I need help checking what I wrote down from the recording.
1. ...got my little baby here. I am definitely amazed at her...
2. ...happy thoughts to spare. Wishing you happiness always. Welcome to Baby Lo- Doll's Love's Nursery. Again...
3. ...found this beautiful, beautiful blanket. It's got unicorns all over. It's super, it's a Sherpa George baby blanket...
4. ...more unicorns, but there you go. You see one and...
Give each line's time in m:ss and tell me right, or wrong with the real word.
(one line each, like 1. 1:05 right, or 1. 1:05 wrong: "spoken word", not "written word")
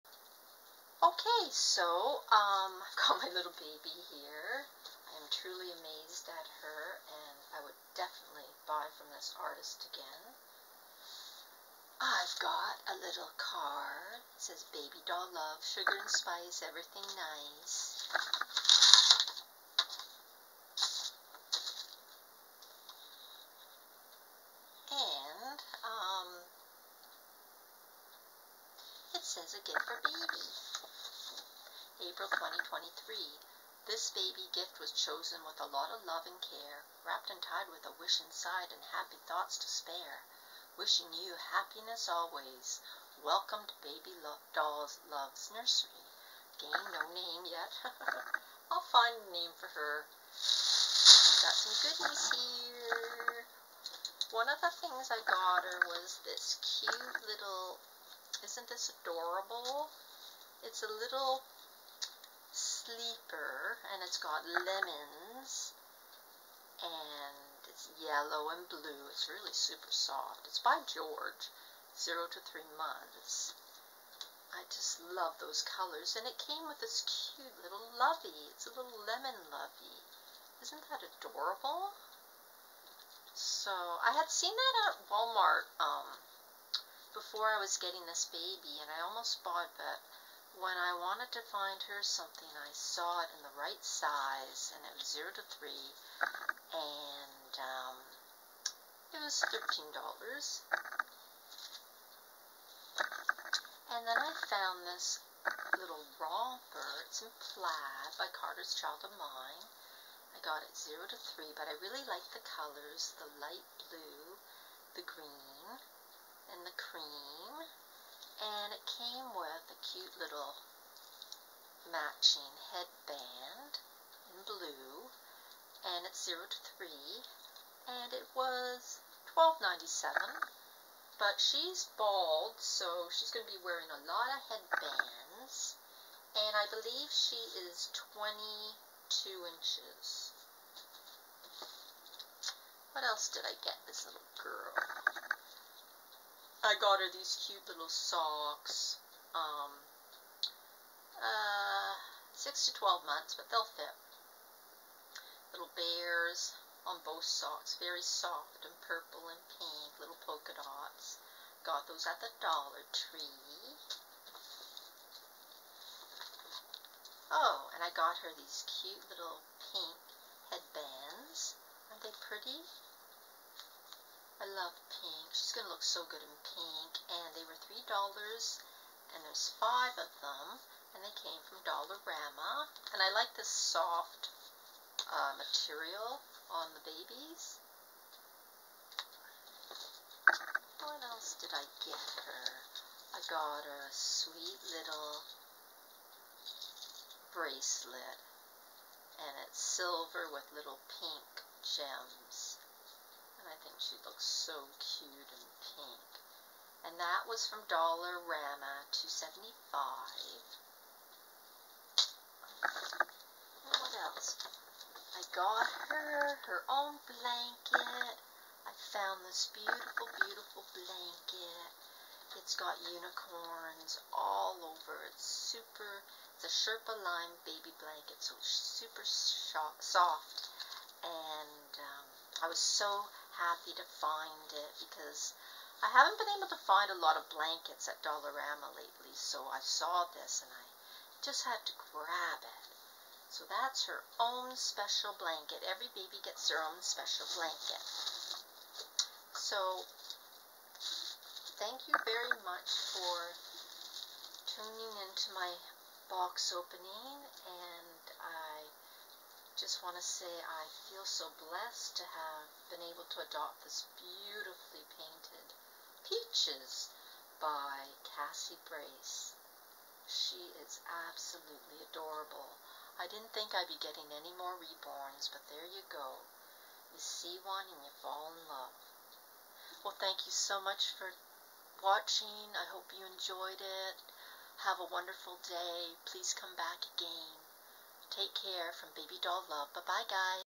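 1. 0:03 wrong: "truly", not "definitely"
2. 0:38 right
3. 3:38 wrong: "Lime", not "George"
4. 4:34 wrong: "reborns", not "unicorns".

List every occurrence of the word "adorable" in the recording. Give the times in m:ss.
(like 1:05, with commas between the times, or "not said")
0:58, 1:21, 4:31.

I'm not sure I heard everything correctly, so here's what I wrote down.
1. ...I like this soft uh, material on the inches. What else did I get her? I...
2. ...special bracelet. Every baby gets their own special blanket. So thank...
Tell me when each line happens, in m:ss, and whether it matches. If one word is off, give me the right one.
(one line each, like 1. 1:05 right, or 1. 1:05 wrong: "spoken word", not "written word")
1. 3:03 wrong: "babies", not "inches"
2. 4:04 wrong: "blanket", not "bracelet".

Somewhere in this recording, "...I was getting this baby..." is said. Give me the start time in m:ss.
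1:27.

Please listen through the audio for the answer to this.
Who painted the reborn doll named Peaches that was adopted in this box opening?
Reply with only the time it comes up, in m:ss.
4:28.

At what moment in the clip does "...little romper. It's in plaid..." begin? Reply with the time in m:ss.
1:45.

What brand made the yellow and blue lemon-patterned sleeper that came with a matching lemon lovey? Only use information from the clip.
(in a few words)
George.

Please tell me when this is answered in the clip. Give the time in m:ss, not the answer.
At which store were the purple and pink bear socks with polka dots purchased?
2:42.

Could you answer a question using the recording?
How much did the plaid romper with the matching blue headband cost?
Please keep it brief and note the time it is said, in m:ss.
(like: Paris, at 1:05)
$12.97, at 2:09.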